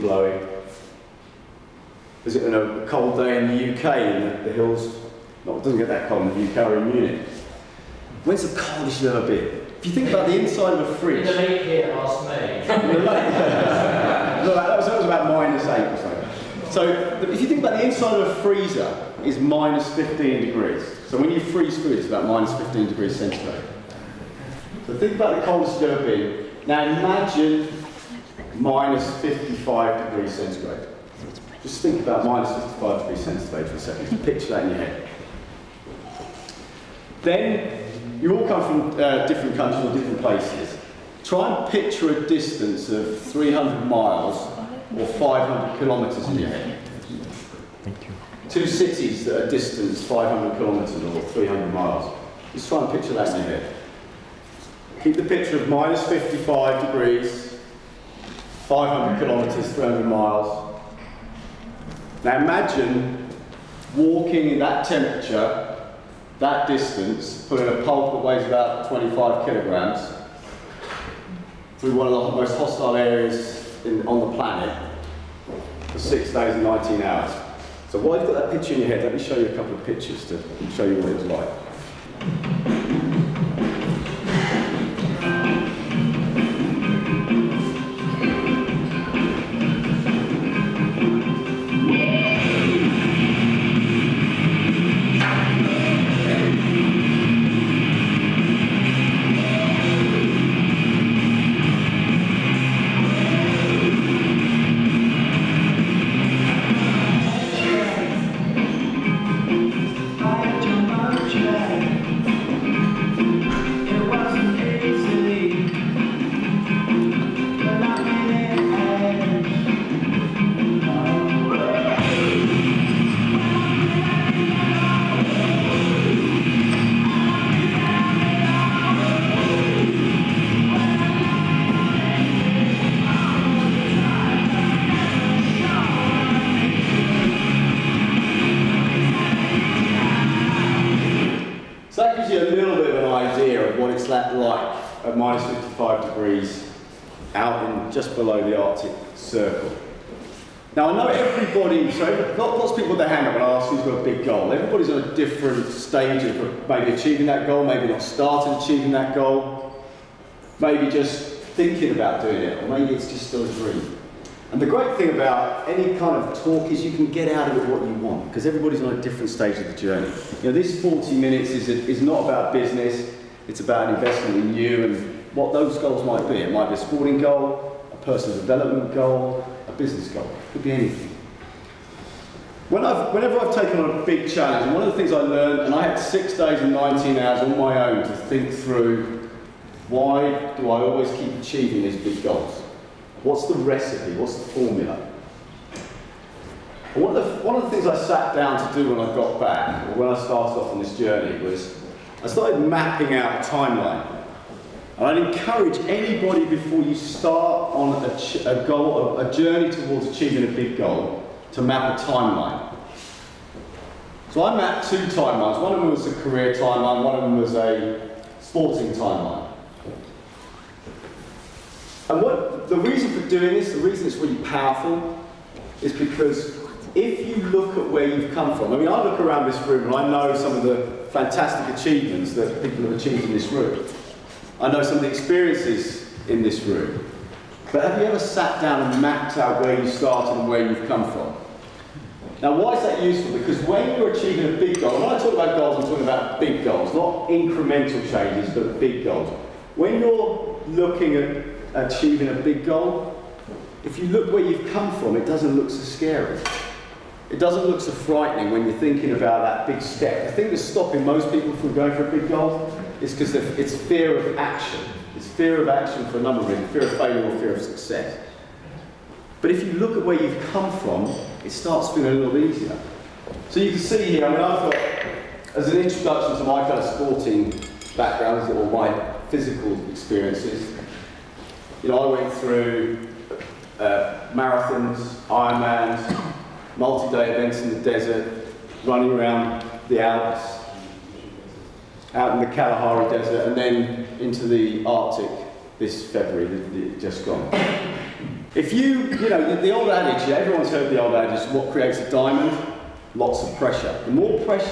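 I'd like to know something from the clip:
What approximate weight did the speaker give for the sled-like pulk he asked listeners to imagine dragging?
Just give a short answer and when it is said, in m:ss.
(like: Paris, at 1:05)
25 kilograms, at 1:08.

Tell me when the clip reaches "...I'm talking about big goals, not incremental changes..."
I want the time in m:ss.
4:05.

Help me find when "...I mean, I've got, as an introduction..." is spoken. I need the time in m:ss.
4:34.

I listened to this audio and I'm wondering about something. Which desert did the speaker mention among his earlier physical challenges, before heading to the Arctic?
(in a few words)
Kalahari Desert.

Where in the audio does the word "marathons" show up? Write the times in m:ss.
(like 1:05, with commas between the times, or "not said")
4:44.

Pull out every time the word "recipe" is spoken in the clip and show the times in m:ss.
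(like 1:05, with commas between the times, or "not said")
3:13.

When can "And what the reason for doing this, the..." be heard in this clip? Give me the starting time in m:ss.
3:42.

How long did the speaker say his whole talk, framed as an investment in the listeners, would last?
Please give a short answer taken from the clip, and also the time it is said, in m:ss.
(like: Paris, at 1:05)
40 minutes, at 2:50.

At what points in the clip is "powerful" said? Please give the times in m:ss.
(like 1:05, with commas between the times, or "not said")
3:44.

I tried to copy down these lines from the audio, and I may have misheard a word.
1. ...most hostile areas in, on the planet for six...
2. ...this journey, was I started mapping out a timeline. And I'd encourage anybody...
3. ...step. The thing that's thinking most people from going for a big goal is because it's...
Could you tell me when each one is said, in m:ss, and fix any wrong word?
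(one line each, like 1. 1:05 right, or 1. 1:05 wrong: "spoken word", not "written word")
1. 1:12 right
2. 3:20 right
3. 4:19 wrong: "stopping", not "thinking".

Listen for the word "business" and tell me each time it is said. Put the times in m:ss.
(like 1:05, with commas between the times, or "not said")
2:52, 2:59.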